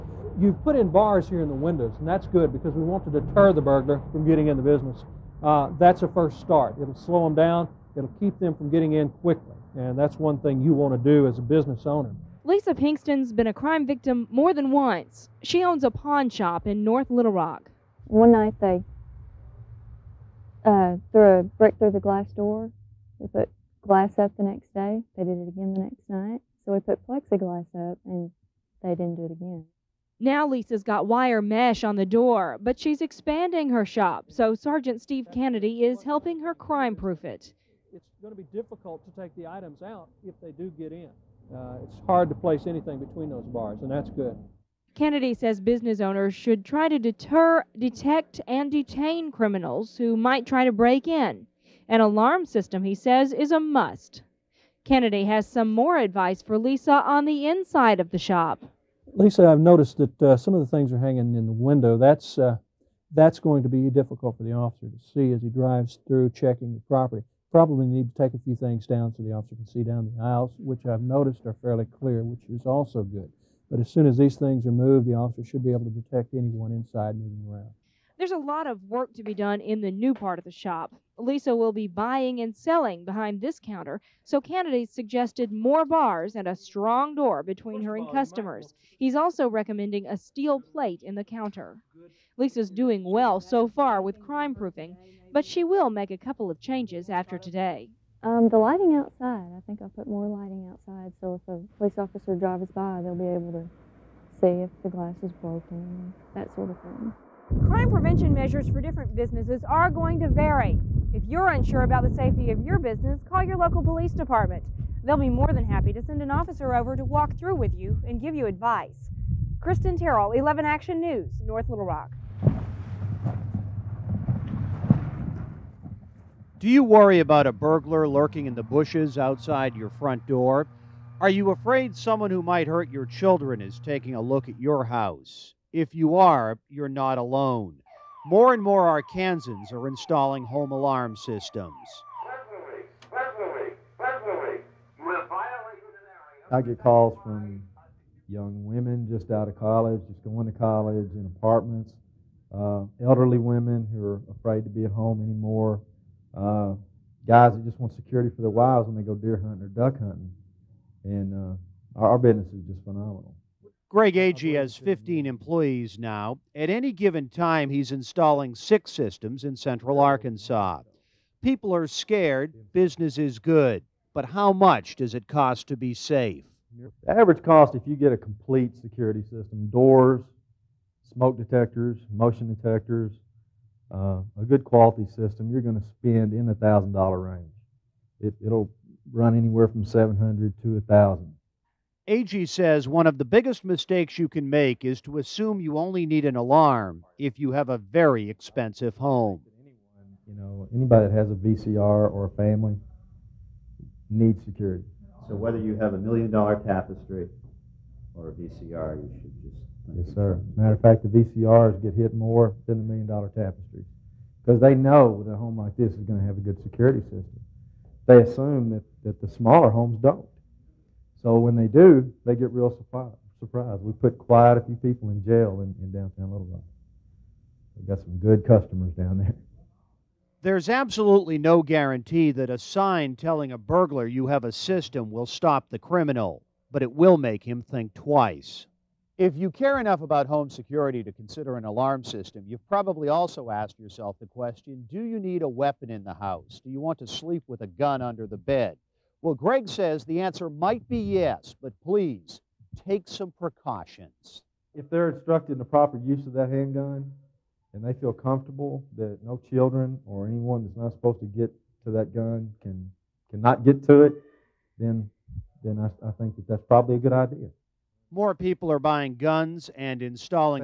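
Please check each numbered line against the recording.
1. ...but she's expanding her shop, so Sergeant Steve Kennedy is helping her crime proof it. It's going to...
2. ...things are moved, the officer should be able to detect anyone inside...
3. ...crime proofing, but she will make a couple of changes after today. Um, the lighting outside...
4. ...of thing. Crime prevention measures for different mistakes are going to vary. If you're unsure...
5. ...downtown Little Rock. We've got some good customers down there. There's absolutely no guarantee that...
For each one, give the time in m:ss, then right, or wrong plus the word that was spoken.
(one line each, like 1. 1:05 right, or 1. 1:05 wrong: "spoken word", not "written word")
1. 0:32 right
2. 1:14 right
3. 1:34 right
4. 1:46 wrong: "businesses", not "mistakes"
5. 3:45 right.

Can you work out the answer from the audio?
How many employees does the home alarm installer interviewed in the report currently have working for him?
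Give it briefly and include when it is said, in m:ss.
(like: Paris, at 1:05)
15, at 2:44.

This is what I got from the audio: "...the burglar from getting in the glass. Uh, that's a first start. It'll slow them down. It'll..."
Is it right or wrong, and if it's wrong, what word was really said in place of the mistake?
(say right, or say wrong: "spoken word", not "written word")
wrong: "business", not "glass".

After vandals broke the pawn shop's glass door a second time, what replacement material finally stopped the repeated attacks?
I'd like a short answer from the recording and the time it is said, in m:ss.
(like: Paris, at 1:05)
Plexiglass, at 0:27.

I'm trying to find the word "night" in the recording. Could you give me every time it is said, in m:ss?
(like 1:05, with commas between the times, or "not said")
0:18, 0:26.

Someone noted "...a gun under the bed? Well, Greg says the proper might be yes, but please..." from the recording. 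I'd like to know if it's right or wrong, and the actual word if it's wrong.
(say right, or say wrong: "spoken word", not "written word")
wrong: "answer", not "proper".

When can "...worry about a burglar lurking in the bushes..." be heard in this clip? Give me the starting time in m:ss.
2:06.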